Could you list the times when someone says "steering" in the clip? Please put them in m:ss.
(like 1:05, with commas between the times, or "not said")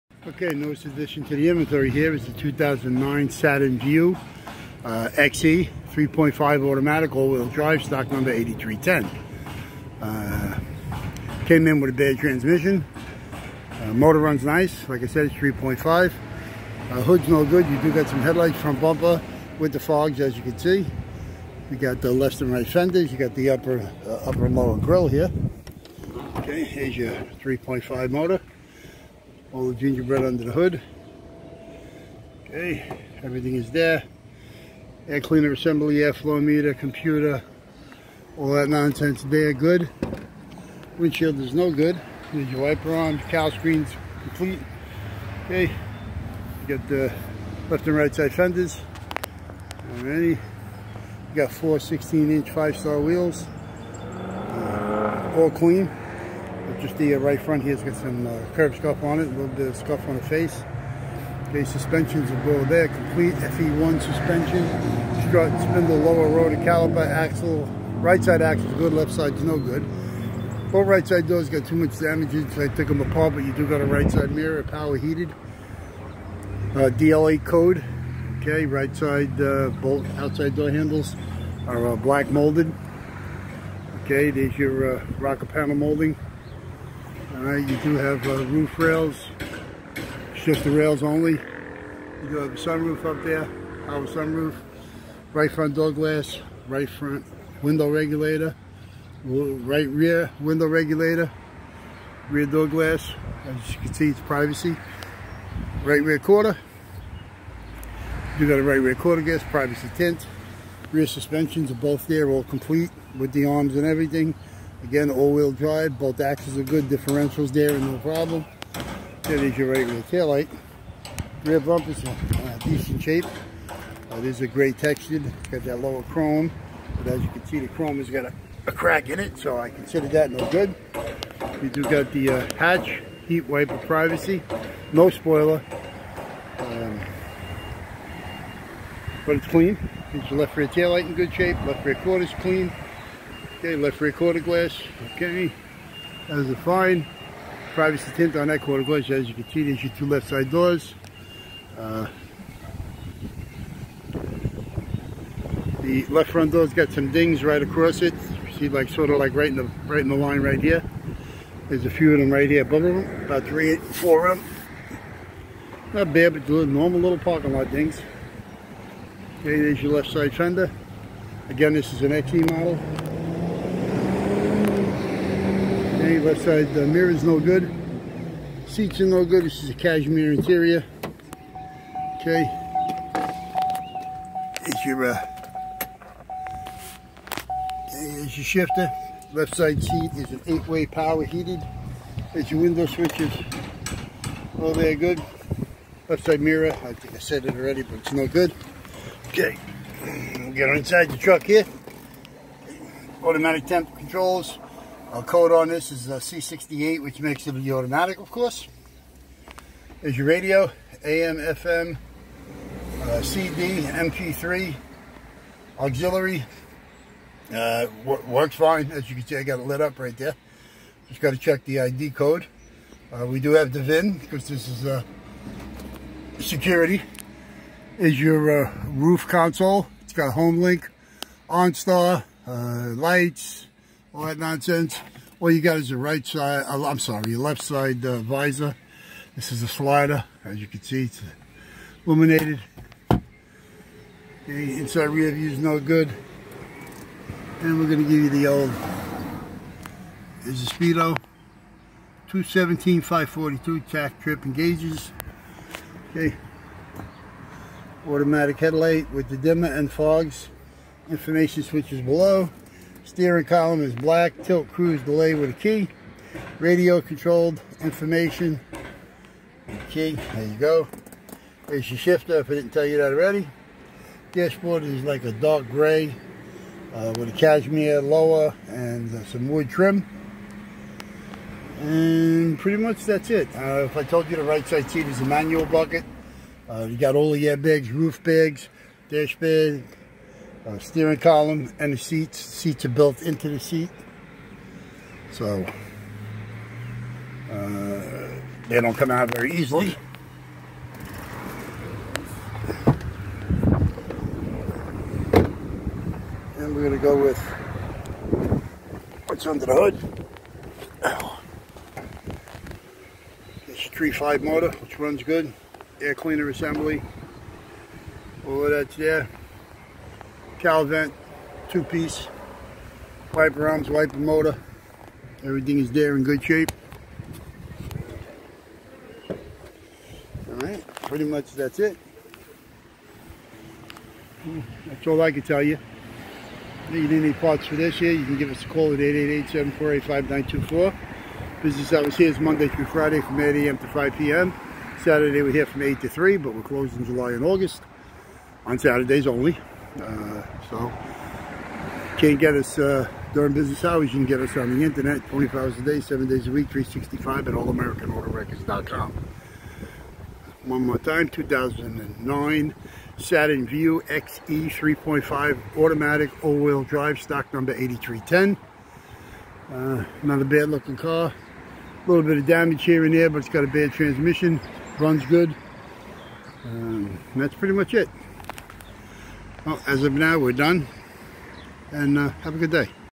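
4:23, 4:50.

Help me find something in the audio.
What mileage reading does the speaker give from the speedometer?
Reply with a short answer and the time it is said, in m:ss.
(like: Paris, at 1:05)
217,542, at 4:12.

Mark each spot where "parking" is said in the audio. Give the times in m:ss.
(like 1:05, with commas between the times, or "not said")
2:47.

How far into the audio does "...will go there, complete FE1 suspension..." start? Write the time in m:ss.
1:02.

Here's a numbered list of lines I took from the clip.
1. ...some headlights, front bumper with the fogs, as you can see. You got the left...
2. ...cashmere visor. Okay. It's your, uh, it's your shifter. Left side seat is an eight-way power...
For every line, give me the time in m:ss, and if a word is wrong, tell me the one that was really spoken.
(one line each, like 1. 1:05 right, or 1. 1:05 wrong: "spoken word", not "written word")
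1. 0:18 right
2. 2:59 wrong: "interior", not "visor".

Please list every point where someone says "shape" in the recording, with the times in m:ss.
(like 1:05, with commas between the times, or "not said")
2:03, 2:21, 5:26.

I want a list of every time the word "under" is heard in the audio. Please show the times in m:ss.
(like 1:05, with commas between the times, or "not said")
0:30, 5:09.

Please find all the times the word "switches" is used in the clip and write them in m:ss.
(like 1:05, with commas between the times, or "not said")
3:12, 4:21.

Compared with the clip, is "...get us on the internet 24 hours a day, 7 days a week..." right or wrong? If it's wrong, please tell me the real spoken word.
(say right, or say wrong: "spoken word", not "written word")
right.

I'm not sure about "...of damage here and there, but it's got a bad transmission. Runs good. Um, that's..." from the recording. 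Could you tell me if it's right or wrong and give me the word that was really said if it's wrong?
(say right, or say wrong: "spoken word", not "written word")
right.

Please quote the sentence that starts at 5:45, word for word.
Saturday we're here from 8 to 3, but we're closed in July and August on Saturdays only.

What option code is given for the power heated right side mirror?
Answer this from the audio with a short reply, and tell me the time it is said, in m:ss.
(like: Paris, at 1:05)
DLA, at 1:16.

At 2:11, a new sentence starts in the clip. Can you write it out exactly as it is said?
We do got the uh, hatch, heat wiper privacy, no spoiler, um, but it's clean.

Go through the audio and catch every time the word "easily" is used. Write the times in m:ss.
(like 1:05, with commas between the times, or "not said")
4:59.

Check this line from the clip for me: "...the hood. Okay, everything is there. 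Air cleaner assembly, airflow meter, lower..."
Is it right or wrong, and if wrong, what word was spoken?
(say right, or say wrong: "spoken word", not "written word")
wrong: "computer", not "lower".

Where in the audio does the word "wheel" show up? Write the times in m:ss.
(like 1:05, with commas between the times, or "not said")
0:07, 0:53, 1:55, 6:06.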